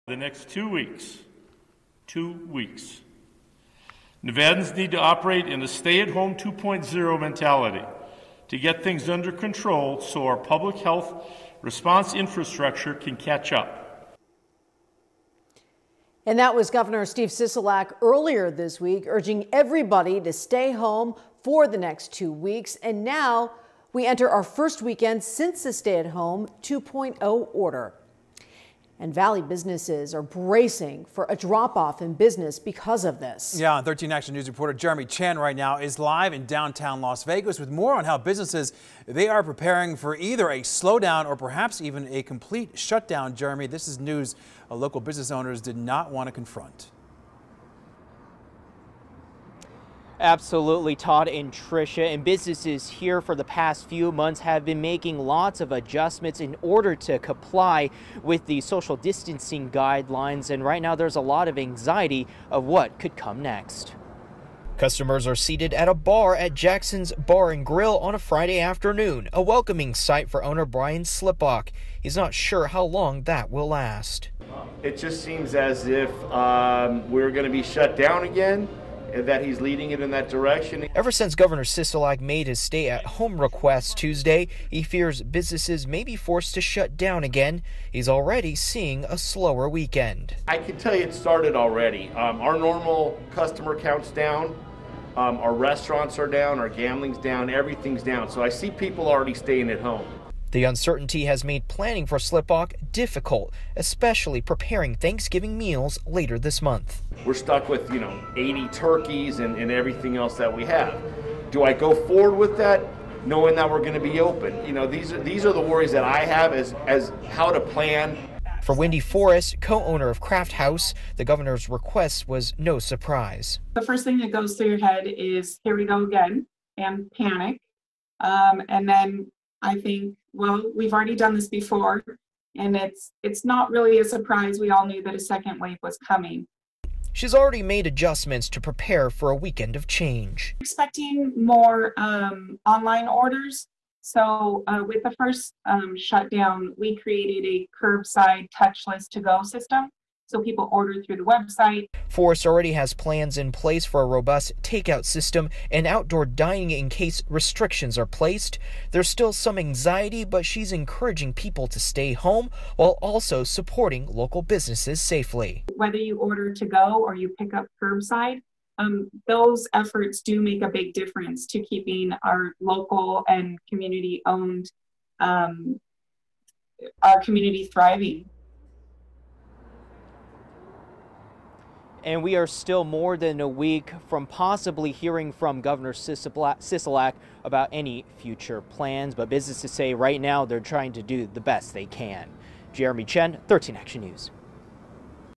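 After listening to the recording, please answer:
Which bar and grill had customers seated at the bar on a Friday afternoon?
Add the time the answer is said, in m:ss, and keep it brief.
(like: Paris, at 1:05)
Jackson's Bar and Grill, at 1:06.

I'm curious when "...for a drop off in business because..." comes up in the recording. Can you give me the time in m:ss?
0:31.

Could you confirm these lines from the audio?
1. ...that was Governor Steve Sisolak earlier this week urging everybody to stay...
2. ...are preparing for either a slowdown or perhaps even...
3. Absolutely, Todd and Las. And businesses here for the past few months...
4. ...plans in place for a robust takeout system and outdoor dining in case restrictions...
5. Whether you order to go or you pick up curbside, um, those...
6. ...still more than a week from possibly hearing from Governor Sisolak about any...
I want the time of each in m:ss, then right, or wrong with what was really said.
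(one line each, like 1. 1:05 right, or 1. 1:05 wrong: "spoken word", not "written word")
1. 0:16 right
2. 0:39 right
3. 0:50 wrong: "Tricia", not "Las"
4. 2:32 right
5. 2:45 right
6. 3:02 right.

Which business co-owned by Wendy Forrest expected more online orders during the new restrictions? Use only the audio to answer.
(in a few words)
Craft House.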